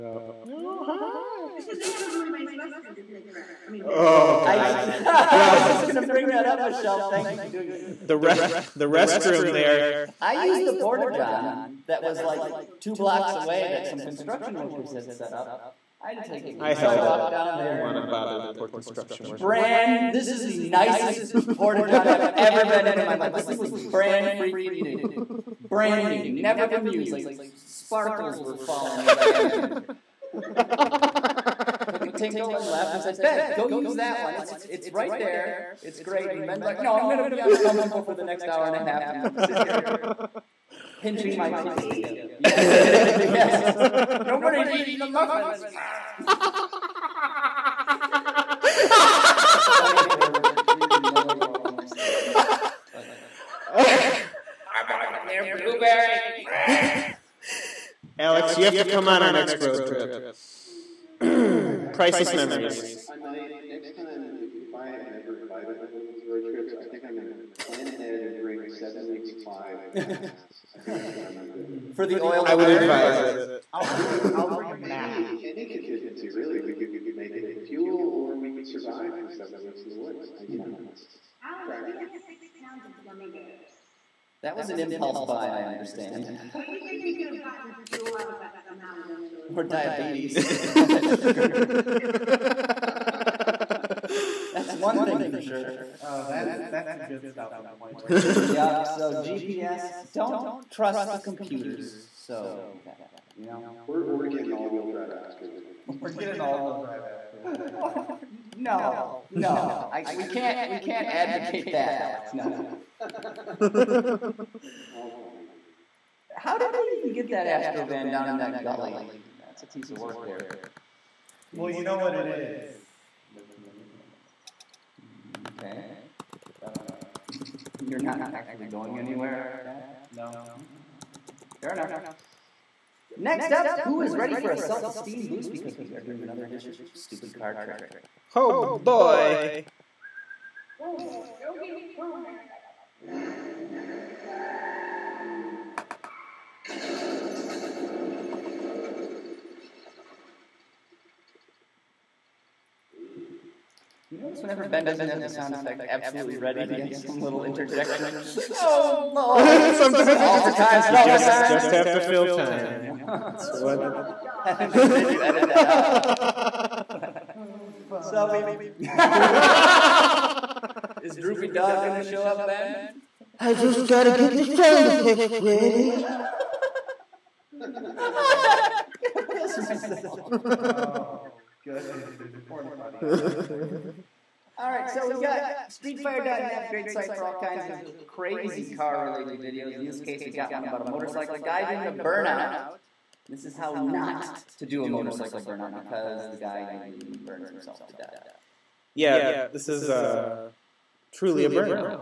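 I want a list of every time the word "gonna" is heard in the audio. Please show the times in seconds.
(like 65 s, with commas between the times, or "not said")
5 s, 171 s, 177 s.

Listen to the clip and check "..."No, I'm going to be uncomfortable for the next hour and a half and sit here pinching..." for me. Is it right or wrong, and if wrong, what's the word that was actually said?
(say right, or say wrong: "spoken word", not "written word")
right.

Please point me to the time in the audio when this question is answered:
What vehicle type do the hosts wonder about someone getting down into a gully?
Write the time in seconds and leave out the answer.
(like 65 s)
117 s.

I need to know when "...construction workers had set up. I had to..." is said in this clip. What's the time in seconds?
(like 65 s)
14 s.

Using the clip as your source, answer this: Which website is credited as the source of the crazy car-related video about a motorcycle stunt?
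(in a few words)
StreetFire.net.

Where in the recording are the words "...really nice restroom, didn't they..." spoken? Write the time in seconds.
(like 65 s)
2 s.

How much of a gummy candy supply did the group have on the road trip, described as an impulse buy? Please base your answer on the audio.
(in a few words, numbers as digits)
6 pounds.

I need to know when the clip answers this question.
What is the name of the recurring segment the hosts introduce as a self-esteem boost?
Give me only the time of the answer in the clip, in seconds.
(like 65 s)
136 s.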